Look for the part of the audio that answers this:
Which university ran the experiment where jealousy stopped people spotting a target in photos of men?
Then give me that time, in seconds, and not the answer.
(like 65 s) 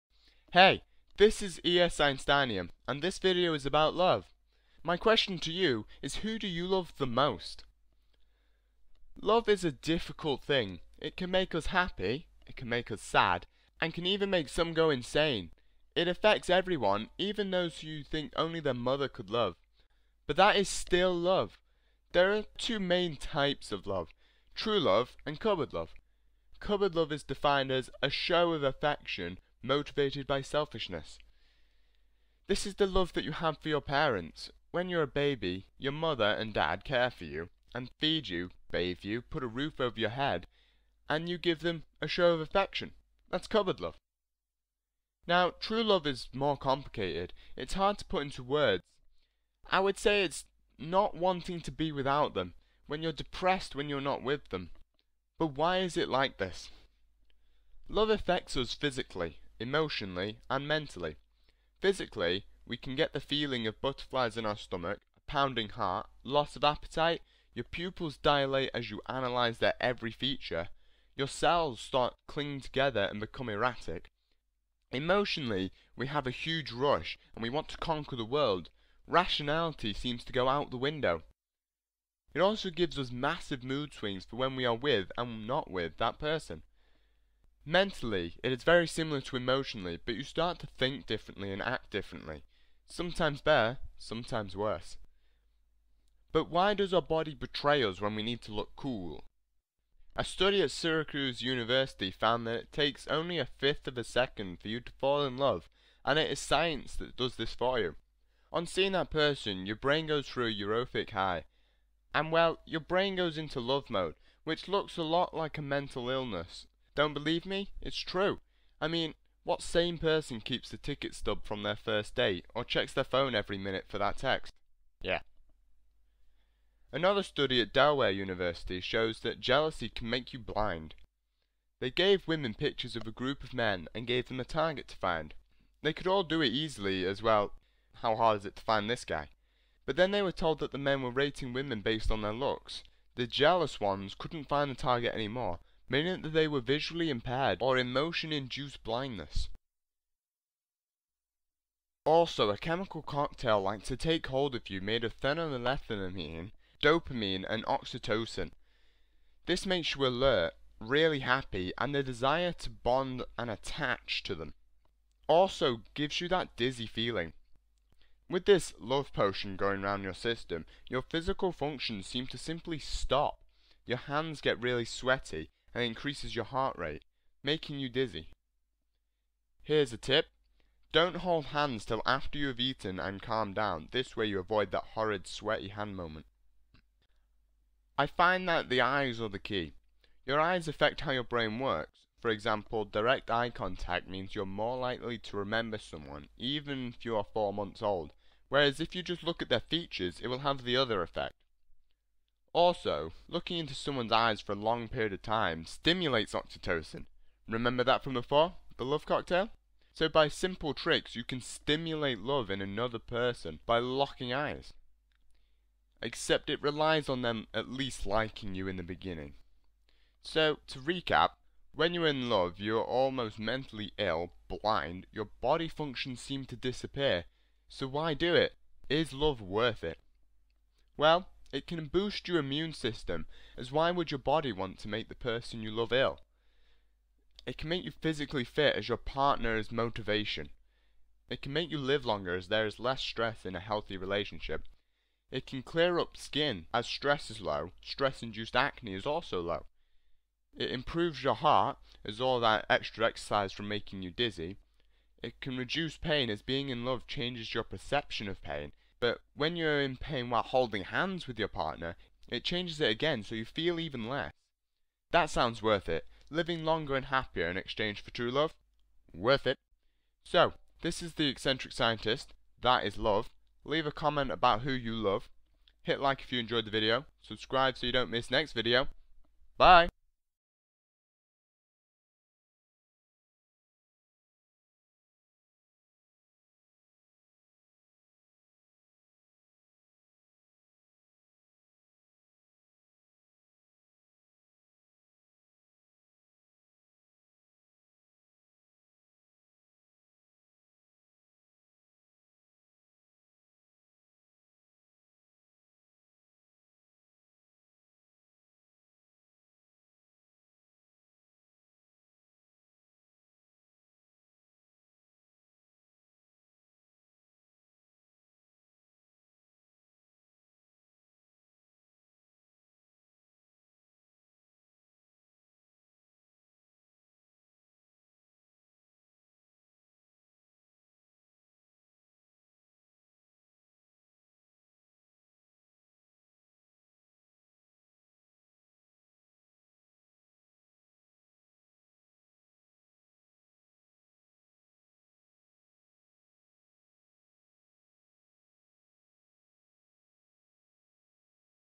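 127 s.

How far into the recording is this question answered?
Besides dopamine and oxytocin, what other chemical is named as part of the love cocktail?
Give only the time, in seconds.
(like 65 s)
155 s.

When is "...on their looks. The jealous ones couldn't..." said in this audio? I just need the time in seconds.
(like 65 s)
142 s.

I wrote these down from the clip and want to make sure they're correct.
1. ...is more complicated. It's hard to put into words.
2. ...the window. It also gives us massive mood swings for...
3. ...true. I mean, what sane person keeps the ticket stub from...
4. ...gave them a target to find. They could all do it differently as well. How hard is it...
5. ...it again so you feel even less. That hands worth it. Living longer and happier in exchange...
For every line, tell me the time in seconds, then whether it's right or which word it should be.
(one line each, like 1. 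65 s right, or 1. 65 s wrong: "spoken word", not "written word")
1. 46 s right
2. 80 s right
3. 117 s right
4. 134 s wrong: "easily", not "differently"
5. 262 s wrong: "sounds", not "hands".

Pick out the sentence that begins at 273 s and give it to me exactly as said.
Leave a comment about who you love.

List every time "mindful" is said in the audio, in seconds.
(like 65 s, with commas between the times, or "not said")
not said.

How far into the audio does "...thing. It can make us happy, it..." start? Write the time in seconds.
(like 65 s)
10 s.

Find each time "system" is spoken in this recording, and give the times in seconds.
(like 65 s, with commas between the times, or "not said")
170 s, 232 s.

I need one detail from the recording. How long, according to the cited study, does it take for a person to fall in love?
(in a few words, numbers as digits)
A fifth of a second.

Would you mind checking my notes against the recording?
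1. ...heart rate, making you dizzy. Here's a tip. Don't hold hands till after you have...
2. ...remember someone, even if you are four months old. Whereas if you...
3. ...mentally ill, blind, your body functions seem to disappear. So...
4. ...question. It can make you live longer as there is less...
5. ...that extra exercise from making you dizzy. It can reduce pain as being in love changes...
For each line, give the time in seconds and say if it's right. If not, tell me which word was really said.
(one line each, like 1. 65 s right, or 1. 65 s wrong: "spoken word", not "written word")
1. 176 s right
2. 195 s right
3. 223 s right
4. 239 s wrong: "motivation", not "question"
5. 252 s right.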